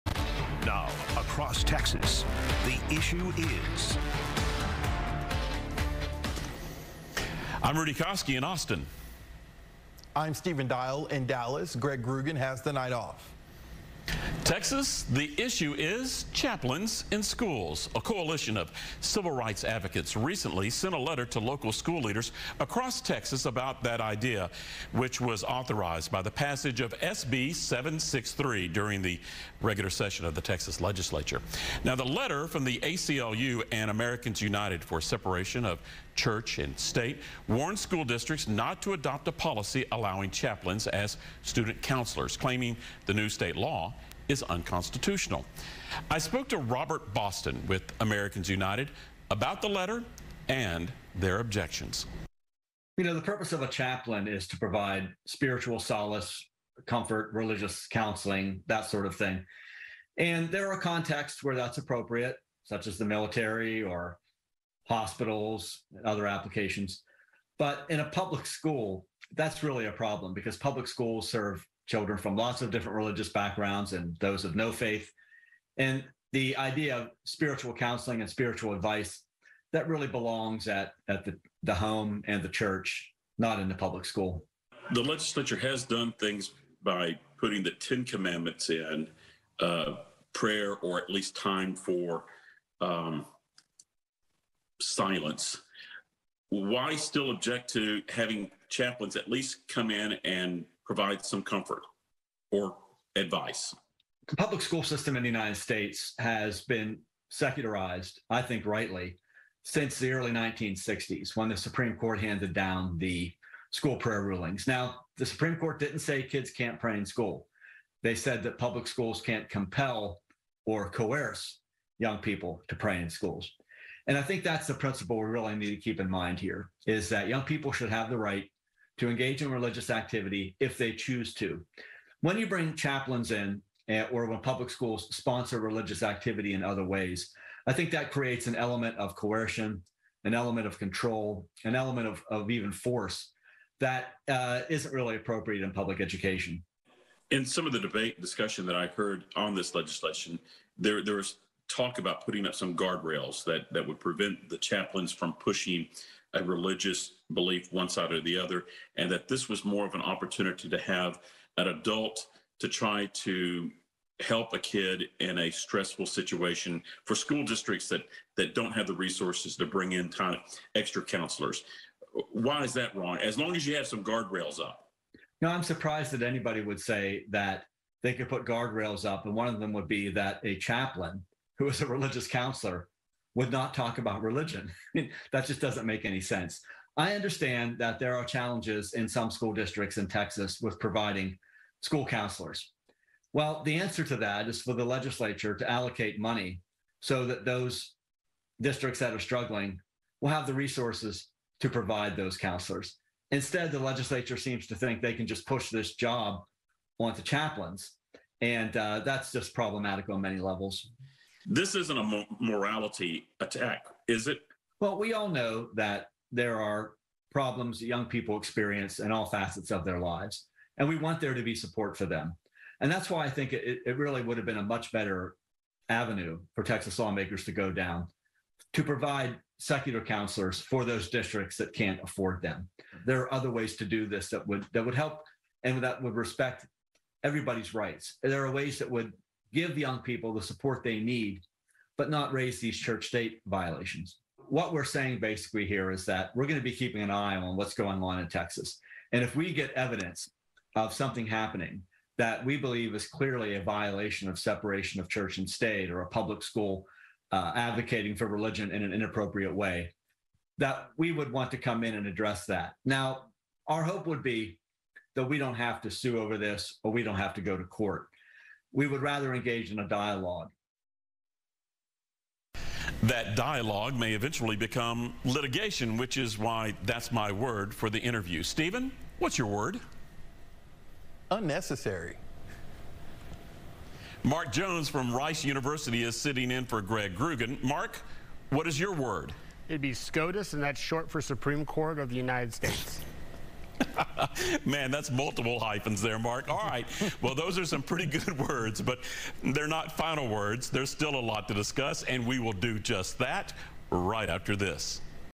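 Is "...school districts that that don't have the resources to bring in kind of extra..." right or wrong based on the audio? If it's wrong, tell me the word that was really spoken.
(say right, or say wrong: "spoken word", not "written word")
right.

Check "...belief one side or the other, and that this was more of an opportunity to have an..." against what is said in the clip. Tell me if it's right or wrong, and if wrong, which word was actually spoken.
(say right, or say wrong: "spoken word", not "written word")
right.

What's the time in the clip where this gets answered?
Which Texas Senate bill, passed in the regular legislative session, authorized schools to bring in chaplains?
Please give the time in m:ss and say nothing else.
0:27.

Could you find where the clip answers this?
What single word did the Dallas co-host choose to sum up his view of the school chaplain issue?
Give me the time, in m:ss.
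4:41.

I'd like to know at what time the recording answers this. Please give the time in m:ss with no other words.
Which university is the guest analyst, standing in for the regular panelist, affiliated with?
4:45.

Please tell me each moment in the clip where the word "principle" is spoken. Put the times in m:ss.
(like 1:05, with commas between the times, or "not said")
2:04.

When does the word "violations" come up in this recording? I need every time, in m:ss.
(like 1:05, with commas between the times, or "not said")
4:03, 4:13.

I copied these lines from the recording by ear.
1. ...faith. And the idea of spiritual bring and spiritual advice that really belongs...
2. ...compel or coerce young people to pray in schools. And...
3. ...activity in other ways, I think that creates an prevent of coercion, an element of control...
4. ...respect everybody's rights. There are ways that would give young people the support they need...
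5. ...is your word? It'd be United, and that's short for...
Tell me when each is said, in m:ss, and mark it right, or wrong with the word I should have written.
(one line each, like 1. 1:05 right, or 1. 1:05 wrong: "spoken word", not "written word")
1. 1:14 wrong: "counseling", not "bring"
2. 1:59 right
3. 2:16 wrong: "element", not "prevent"
4. 3:56 right
5. 4:48 wrong: "SCOTUS", not "United".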